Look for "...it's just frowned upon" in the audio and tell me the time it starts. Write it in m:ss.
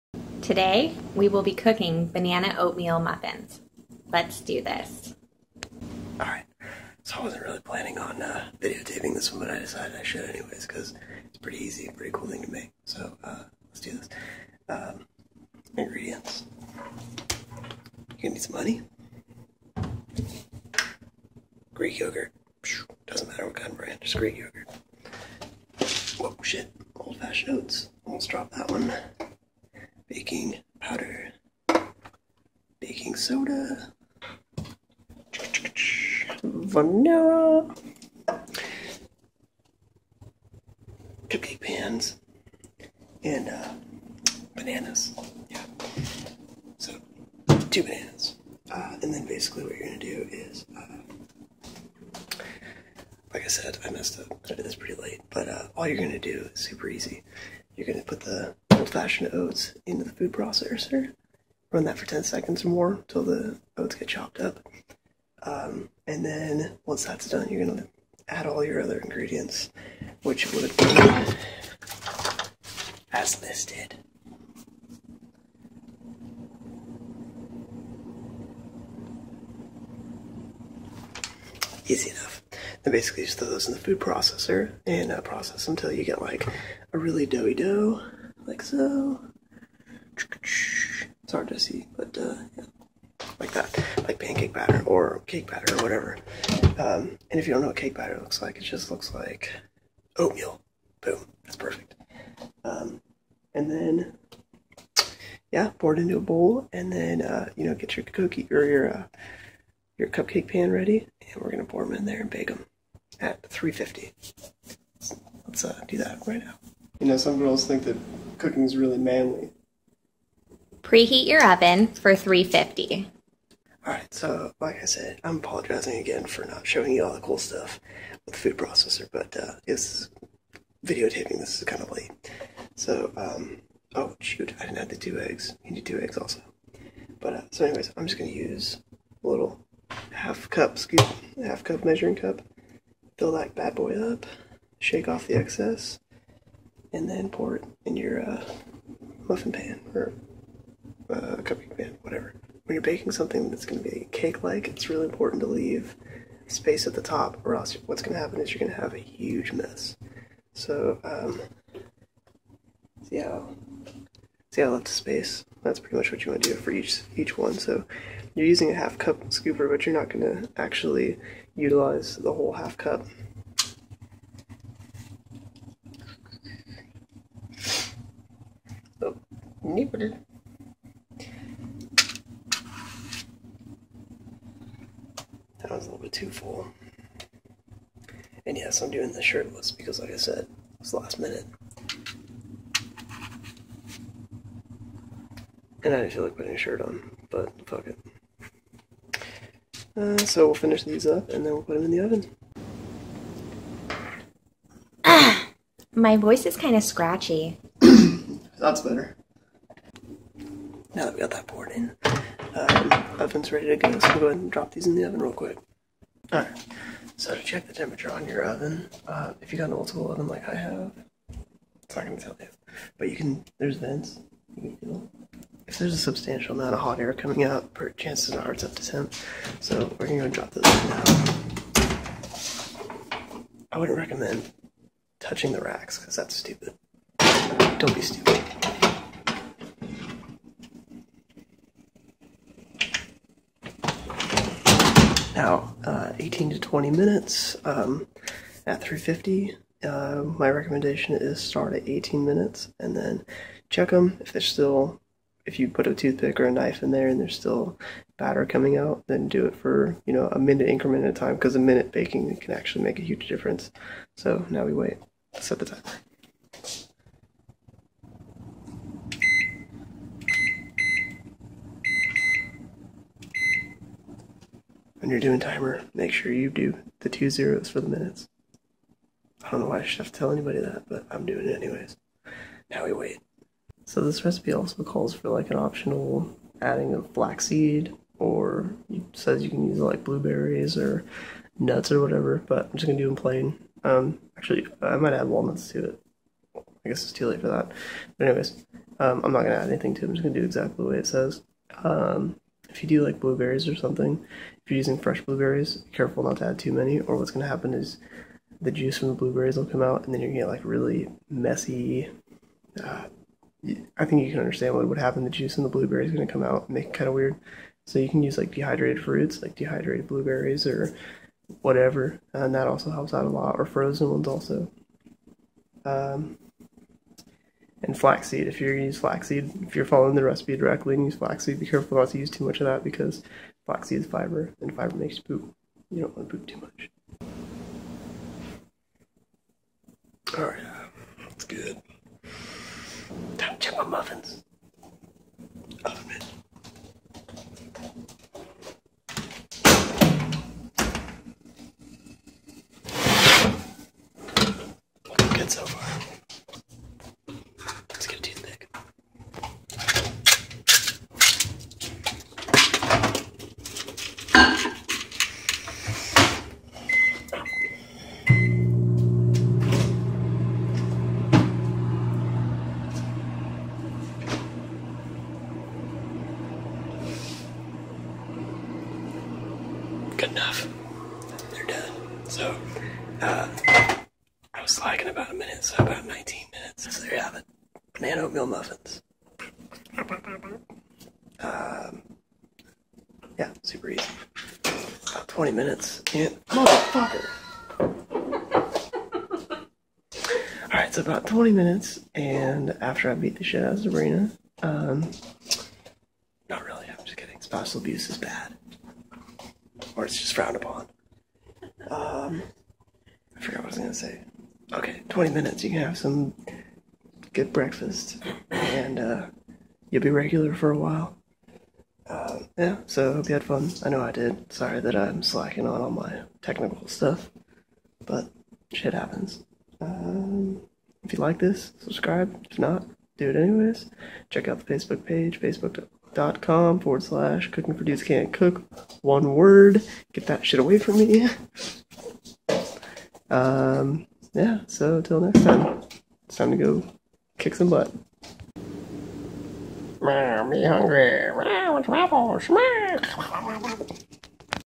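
6:50.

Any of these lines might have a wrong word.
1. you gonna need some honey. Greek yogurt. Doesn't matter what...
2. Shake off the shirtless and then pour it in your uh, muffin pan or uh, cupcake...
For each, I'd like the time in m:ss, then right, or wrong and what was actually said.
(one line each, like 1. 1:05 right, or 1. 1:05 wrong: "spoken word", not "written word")
1. 0:16 right
2. 2:24 wrong: "excess", not "shirtless".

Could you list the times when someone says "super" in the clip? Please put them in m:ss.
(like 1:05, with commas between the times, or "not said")
0:56, 6:33.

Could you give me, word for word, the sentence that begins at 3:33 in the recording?
So we'll go ahead and drop these in the oven real quick.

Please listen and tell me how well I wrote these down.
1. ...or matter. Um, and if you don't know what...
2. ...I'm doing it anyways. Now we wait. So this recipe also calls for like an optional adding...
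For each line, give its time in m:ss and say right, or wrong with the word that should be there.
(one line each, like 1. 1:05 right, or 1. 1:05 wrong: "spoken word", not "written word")
1. 1:35 wrong: "whatever", not "matter"
2. 4:41 right.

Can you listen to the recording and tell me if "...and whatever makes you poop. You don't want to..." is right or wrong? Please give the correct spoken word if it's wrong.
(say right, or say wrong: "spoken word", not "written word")
wrong: "fiber", not "whatever".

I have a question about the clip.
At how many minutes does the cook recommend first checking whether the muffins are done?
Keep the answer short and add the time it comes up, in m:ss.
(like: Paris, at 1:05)
18, at 4:11.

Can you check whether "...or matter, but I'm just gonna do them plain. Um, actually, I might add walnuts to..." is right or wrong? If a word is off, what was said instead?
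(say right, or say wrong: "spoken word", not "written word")
wrong: "whatever", not "matter".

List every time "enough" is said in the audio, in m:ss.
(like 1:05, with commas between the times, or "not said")
1:22, 6:20.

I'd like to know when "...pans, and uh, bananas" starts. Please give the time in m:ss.
0:41.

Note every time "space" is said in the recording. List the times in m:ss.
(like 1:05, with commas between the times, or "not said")
2:36, 2:44.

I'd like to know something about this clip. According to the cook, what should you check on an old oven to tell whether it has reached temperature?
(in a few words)
vents.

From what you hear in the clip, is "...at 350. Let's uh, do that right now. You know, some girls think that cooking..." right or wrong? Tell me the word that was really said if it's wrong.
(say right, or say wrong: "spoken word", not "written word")
right.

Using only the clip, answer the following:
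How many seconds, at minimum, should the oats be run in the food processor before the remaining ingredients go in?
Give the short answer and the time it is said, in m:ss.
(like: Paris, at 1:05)
10, at 1:02.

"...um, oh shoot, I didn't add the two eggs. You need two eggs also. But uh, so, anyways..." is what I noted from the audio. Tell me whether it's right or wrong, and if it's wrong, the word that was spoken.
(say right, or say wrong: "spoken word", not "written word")
right.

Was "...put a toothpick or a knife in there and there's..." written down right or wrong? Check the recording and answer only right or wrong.
right.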